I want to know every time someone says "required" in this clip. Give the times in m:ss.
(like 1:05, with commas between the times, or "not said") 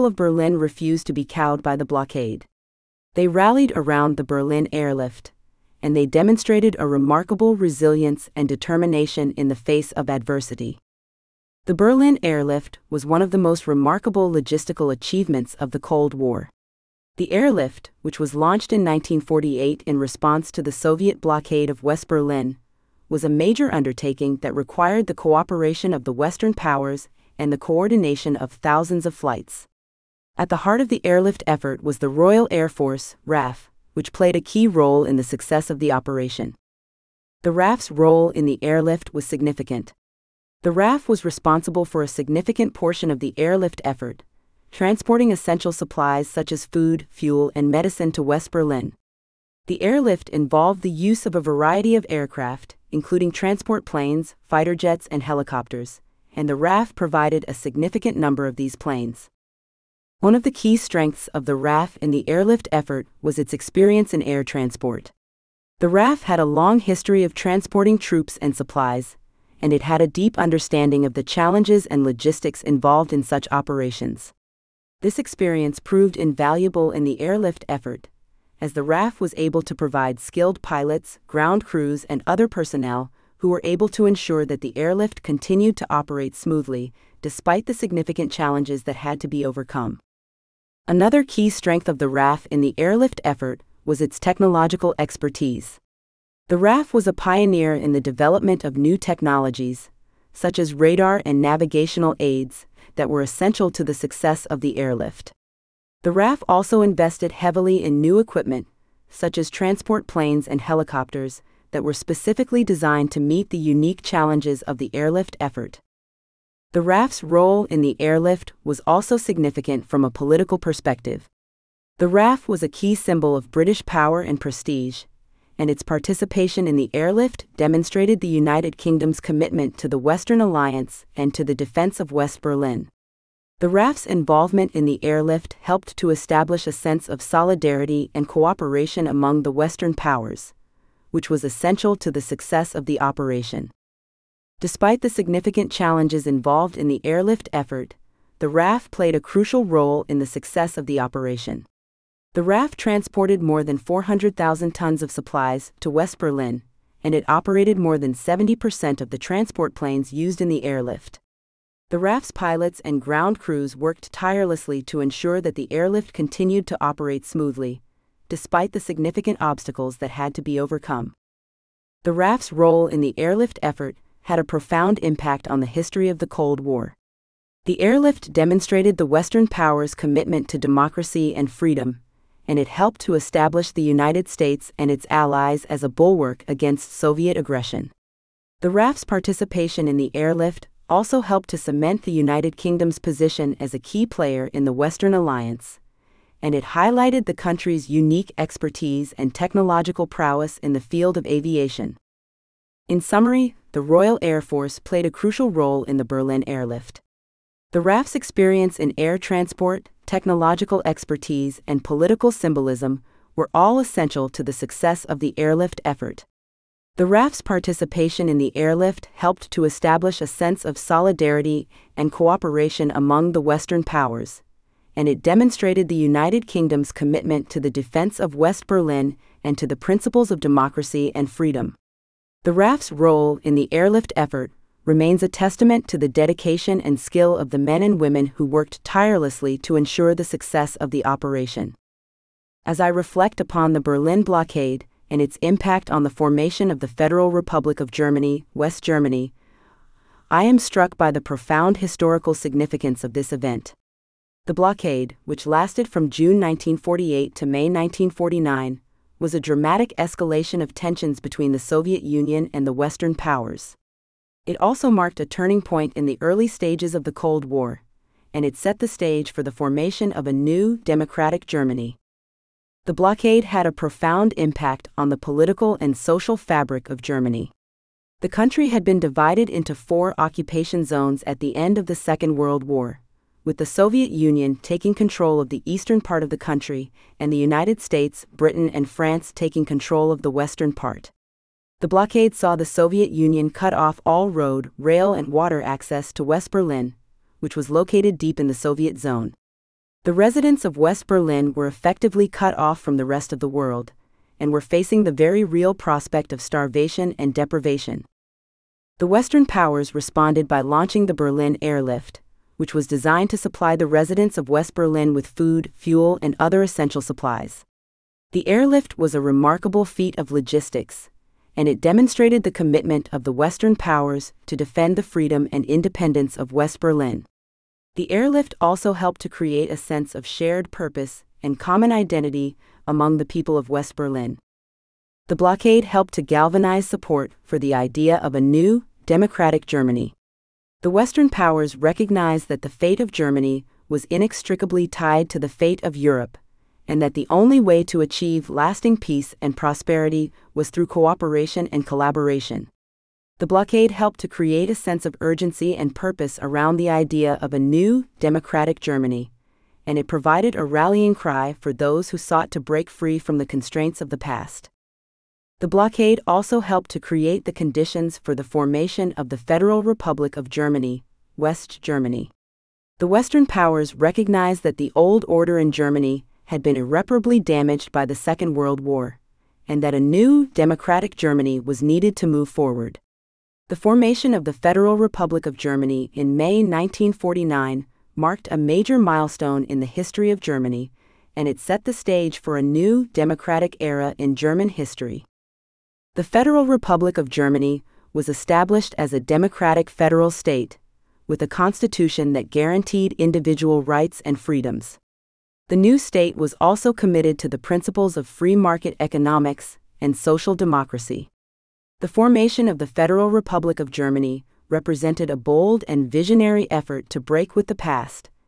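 0:24.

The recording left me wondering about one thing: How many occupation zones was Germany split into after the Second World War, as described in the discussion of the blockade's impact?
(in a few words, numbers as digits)
4.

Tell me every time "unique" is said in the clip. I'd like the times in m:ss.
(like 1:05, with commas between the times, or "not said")
1:53, 3:17.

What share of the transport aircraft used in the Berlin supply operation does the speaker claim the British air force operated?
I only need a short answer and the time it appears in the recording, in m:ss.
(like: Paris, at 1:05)
more than 70%, at 2:37.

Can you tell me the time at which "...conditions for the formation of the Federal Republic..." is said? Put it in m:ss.
6:07.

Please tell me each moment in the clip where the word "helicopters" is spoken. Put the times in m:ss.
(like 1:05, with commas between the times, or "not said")
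0:55, 1:50.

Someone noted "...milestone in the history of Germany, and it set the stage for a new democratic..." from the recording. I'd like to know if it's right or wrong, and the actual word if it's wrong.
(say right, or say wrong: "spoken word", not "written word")
right.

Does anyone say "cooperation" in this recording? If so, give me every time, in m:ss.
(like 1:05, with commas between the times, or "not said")
0:25, 2:18, 3:42, 5:50.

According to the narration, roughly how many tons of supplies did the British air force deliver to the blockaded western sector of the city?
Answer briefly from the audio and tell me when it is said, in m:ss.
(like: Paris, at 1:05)
more than 400,000 tons, at 2:33.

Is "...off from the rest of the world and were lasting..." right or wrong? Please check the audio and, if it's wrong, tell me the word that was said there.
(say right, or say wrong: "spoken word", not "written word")
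wrong: "facing", not "lasting".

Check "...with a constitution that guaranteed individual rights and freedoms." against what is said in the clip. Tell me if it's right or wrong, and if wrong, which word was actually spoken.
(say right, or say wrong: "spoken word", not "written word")
right.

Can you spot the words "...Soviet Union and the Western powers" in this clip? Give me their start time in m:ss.
4:21.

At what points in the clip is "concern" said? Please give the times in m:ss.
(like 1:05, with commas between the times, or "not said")
not said.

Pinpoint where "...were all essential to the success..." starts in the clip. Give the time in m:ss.
3:33.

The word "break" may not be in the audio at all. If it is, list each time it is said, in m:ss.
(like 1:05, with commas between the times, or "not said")
6:02, 6:57.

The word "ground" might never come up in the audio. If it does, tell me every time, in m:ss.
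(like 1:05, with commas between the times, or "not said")
1:21, 2:43.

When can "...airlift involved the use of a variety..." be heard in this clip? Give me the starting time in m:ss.
0:49.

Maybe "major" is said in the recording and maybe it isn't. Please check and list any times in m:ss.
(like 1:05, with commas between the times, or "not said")
0:23, 6:28.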